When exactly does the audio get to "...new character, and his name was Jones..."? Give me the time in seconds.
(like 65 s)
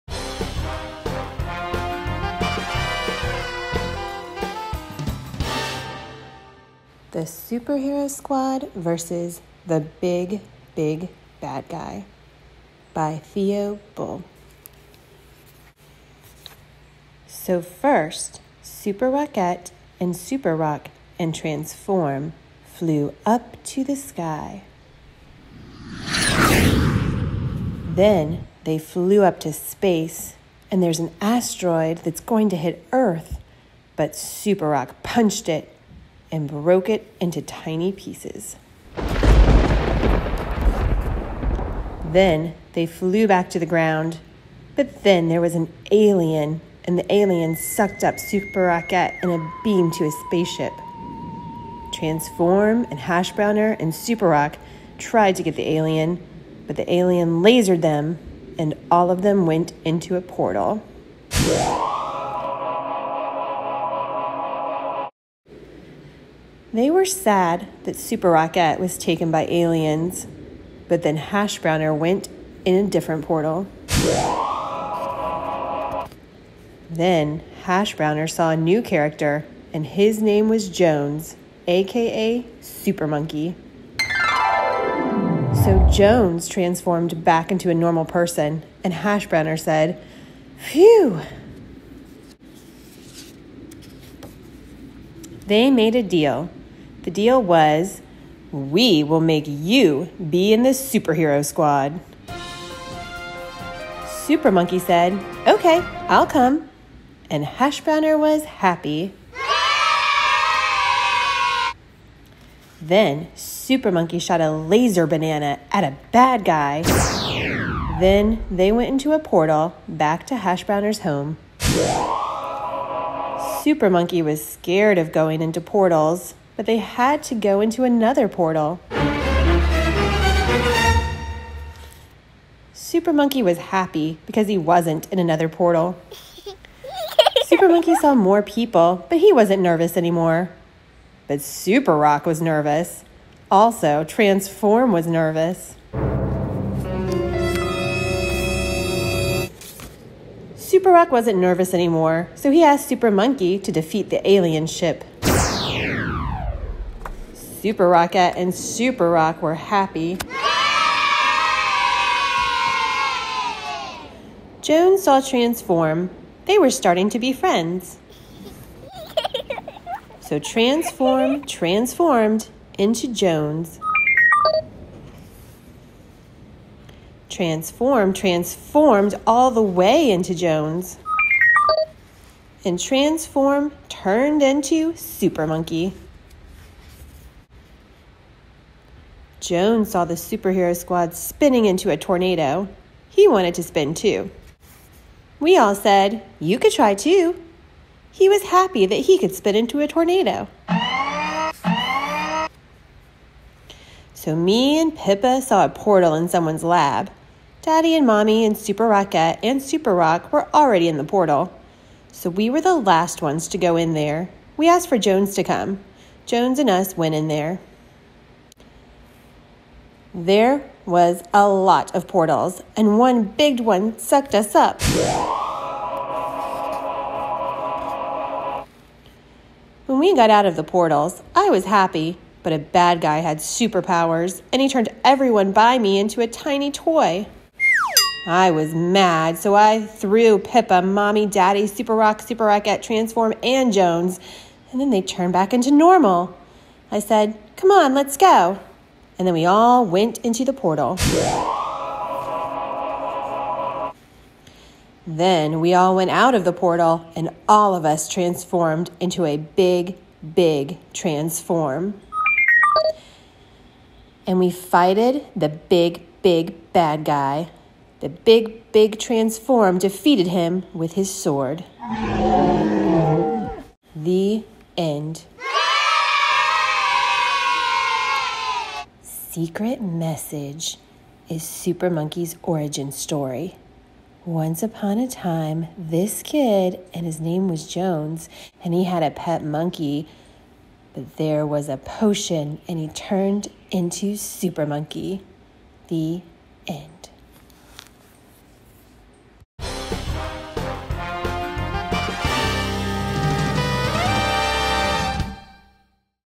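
78 s.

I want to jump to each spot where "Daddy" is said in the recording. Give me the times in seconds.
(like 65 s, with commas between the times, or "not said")
207 s, 241 s.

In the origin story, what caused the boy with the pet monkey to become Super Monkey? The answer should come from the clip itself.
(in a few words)
a potion.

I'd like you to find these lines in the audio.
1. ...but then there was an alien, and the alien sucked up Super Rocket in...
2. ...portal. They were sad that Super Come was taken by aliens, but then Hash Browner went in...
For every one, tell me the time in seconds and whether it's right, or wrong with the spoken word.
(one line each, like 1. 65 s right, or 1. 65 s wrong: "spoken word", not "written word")
1. 44 s right
2. 60 s wrong: "Rocket", not "Come".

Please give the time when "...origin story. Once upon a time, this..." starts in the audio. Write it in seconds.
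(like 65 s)
282 s.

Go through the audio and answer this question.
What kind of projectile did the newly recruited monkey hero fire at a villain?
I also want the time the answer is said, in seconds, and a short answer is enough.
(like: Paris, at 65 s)
laser banana, at 114 s.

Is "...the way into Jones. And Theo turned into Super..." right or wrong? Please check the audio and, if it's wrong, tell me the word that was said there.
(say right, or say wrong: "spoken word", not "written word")
wrong: "Transform", not "Theo".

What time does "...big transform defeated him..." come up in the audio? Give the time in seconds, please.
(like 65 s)
268 s.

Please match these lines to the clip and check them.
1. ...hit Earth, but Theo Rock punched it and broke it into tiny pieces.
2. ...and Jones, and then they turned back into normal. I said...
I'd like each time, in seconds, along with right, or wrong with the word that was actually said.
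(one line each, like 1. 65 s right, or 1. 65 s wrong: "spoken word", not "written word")
1. 32 s wrong: "Super", not "Theo"
2. 243 s right.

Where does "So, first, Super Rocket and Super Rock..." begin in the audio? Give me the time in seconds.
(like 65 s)
17 s.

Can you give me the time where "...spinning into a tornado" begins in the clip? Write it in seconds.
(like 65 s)
191 s.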